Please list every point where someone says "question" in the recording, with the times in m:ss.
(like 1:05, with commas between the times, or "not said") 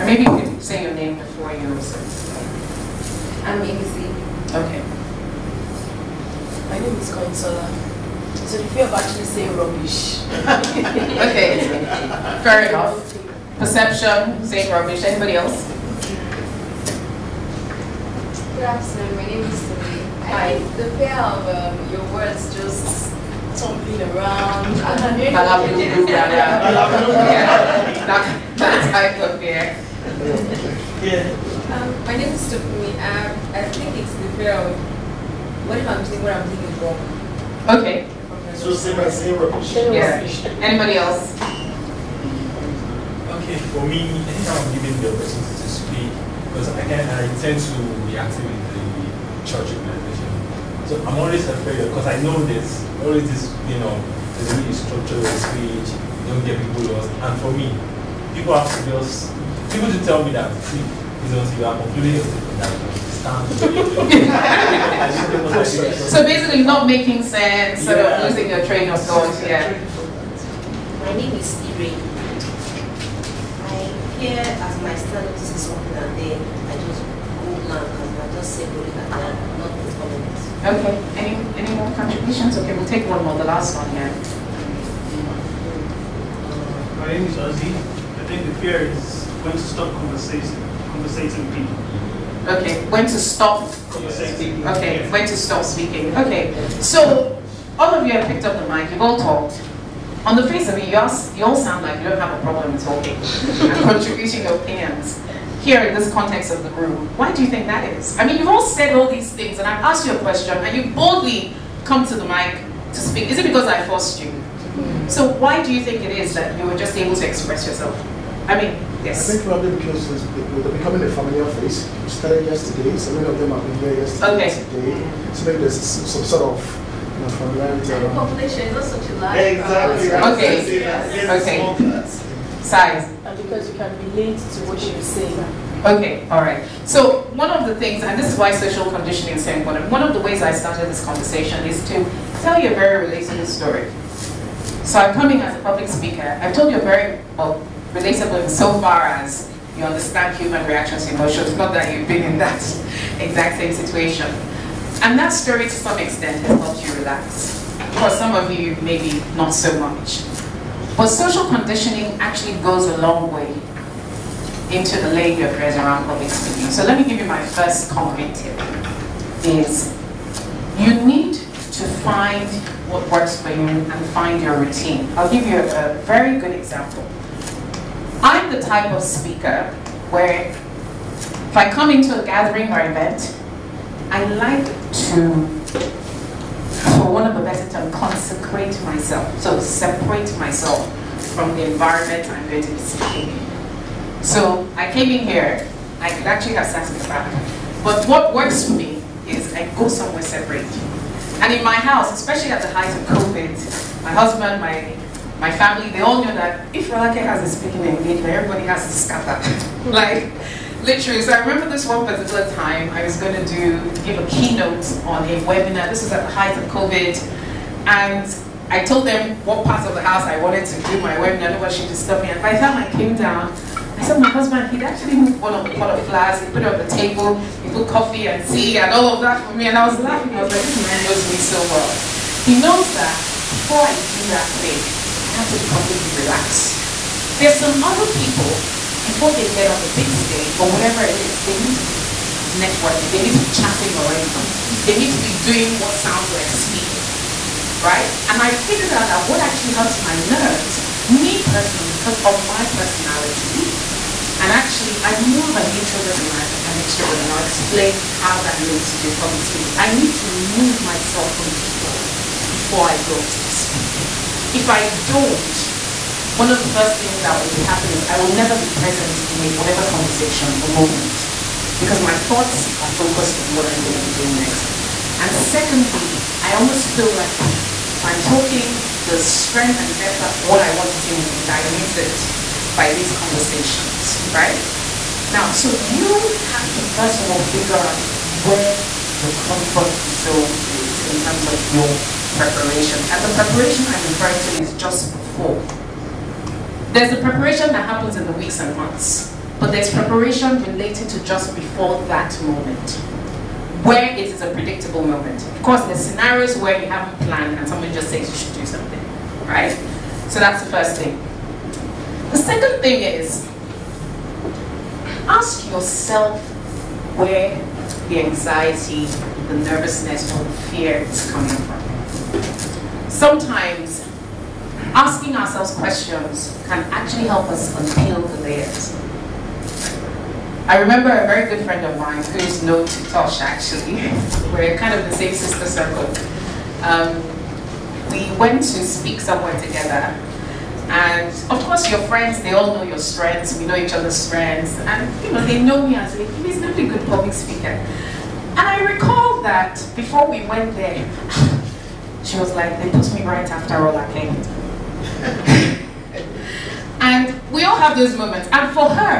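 1:50, 5:25.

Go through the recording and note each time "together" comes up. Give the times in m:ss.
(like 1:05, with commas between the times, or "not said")
5:39.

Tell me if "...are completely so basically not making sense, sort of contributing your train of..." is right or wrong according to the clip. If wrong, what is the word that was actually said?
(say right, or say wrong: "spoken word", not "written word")
wrong: "losing", not "contributing".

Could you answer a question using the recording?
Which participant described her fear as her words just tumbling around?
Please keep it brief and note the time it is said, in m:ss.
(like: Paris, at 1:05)
Sumi, at 0:19.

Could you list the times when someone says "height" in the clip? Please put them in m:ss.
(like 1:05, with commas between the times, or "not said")
3:22, 3:36.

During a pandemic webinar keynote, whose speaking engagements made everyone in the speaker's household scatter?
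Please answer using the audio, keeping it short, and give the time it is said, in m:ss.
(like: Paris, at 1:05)
Rolake, at 3:26.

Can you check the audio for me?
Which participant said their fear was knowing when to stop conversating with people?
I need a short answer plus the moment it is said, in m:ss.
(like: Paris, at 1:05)
Ozzy, at 1:27.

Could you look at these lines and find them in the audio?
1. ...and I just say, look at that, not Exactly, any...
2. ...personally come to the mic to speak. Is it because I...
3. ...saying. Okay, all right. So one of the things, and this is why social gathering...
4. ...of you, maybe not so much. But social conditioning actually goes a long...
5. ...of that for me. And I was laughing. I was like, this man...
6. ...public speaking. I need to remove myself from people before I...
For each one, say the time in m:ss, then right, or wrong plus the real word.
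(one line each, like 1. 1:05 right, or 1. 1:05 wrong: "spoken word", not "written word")
1. 1:17 wrong: "Okay", not "Exactly"
2. 1:50 wrong: "boldly", not "personally"
3. 2:15 wrong: "conditioning", not "gathering"
4. 2:38 right
5. 3:49 right
6. 4:19 right.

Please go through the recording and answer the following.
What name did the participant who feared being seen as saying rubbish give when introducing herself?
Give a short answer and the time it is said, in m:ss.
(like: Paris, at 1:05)
Consola, at 0:07.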